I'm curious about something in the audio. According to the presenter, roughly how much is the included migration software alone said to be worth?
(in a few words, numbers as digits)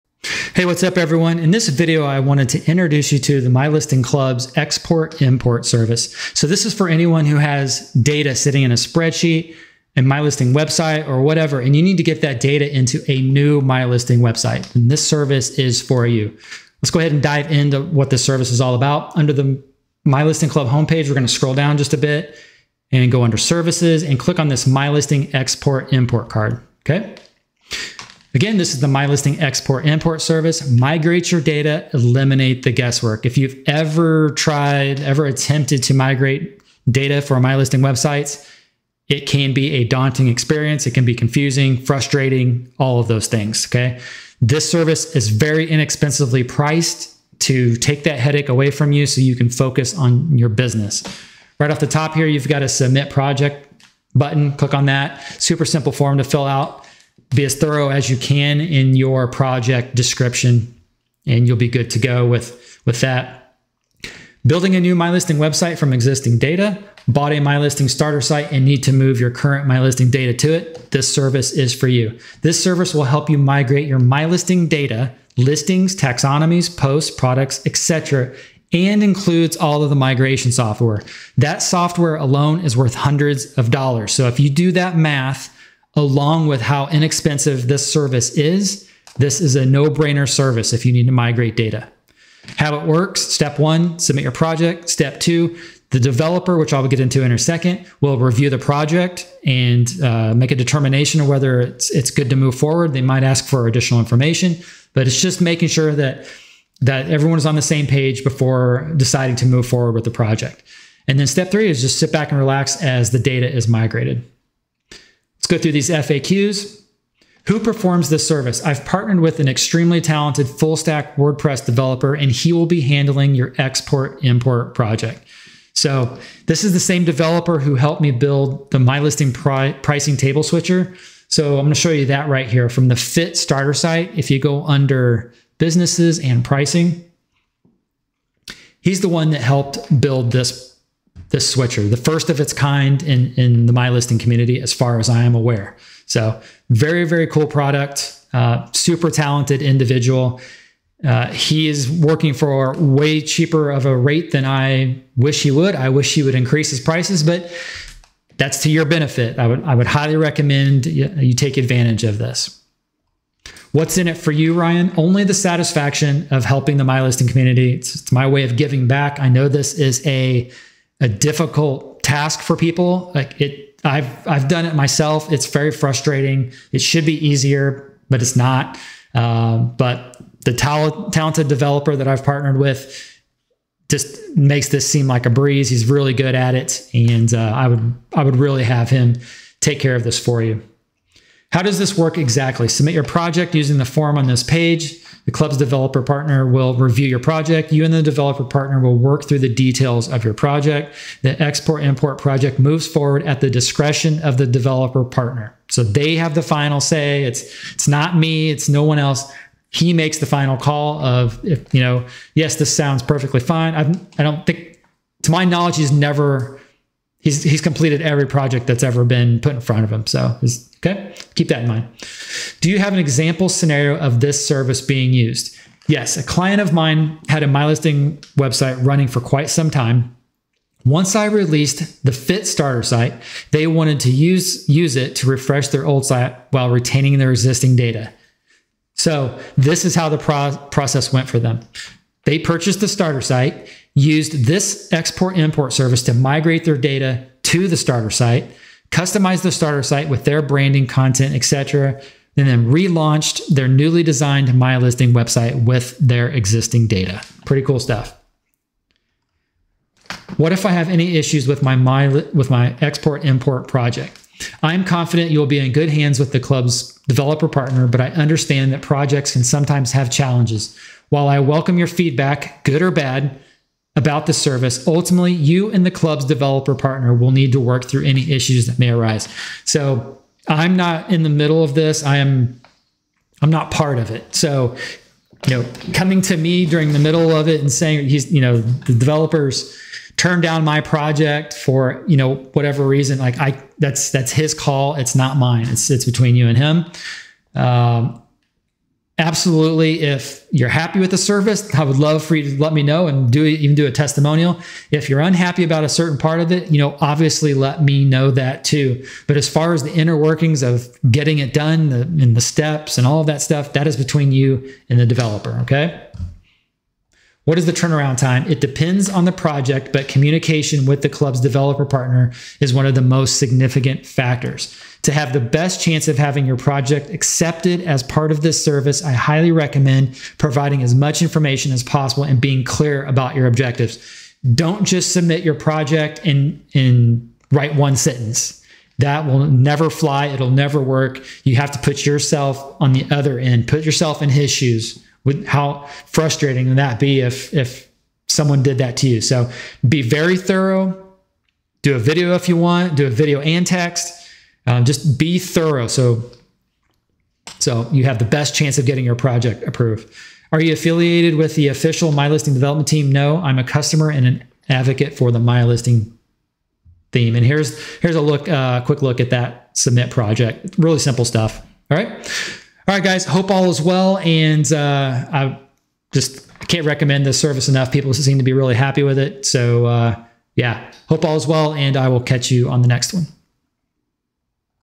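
Hundreds of dollars.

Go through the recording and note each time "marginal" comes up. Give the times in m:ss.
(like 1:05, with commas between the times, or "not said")
not said.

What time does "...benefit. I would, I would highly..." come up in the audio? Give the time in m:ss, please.
2:38.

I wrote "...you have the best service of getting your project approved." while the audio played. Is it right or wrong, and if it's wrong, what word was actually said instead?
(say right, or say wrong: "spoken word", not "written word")
wrong: "chance", not "service".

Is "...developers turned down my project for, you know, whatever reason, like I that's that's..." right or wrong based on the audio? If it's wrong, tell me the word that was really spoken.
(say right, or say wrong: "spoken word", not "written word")
right.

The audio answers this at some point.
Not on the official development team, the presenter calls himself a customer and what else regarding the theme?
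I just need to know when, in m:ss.
6:04.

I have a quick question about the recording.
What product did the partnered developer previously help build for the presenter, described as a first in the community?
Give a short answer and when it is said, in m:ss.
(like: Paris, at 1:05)
Pricing table switcher, at 2:09.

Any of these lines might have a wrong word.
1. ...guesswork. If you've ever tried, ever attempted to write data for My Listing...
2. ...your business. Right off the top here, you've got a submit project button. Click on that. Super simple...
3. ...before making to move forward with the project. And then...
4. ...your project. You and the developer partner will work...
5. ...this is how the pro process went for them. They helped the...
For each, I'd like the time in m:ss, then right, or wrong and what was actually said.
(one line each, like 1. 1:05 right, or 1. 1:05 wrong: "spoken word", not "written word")
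1. 0:32 wrong: "migrate", not "write"
2. 0:50 right
3. 1:48 wrong: "deciding", not "making"
4. 3:17 right
5. 3:59 wrong: "purchased", not "helped".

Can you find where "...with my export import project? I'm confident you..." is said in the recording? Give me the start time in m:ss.
4:22.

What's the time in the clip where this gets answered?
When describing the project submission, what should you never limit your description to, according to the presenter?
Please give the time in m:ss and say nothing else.
5:37.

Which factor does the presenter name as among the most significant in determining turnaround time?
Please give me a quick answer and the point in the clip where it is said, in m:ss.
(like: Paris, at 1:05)
Communication, at 5:20.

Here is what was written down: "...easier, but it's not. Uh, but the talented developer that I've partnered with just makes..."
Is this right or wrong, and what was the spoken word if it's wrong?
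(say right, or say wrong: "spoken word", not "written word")
right.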